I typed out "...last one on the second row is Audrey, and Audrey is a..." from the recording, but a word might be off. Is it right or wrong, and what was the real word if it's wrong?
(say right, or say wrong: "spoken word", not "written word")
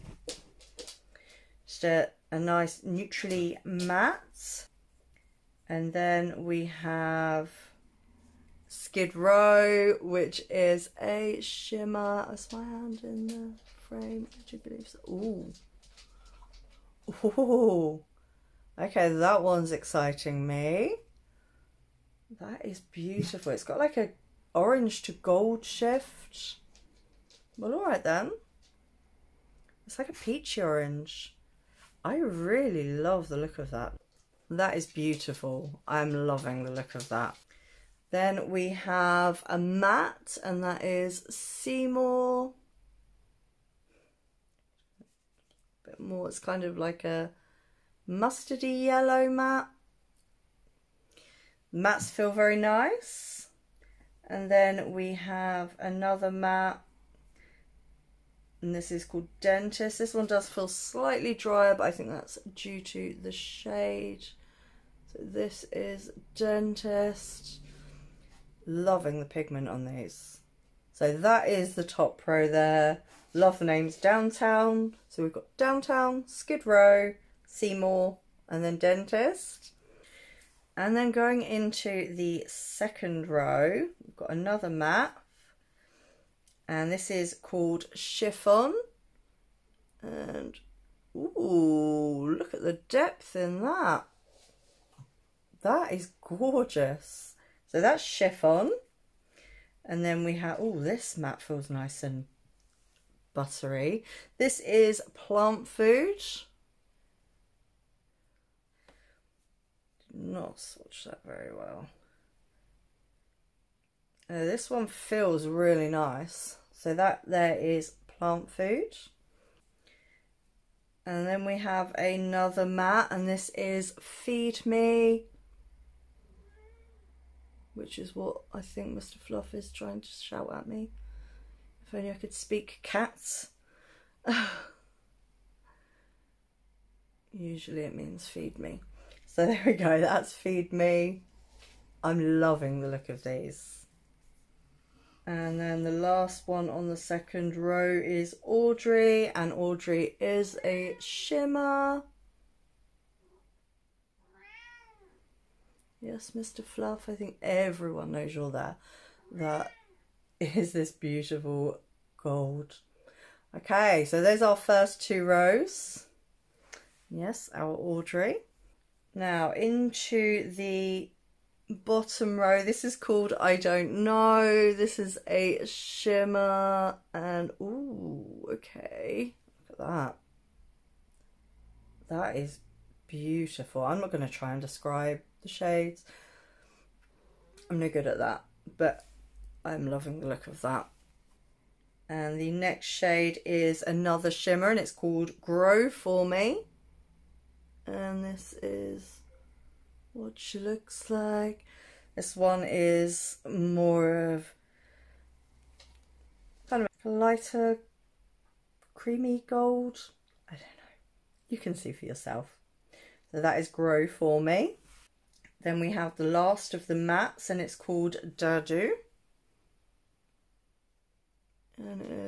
right.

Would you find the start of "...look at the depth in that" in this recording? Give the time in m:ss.
1:32.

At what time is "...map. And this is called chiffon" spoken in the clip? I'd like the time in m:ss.
1:24.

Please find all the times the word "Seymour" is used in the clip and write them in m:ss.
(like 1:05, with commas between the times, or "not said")
0:41, 1:17.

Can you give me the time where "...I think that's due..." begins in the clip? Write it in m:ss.
1:01.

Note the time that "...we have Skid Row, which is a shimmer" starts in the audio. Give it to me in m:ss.
0:06.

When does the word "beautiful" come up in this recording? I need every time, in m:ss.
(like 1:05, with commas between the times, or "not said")
0:22, 0:34, 2:40, 3:03.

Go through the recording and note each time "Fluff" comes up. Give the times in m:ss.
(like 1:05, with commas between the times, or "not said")
2:09, 2:36.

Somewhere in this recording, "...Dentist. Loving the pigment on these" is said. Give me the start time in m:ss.
1:06.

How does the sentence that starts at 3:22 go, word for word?
This one is more of kind of a lighter creamy gold.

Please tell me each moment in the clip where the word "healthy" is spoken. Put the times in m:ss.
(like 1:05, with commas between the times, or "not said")
not said.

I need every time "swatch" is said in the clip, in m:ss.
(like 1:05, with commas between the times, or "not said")
1:50.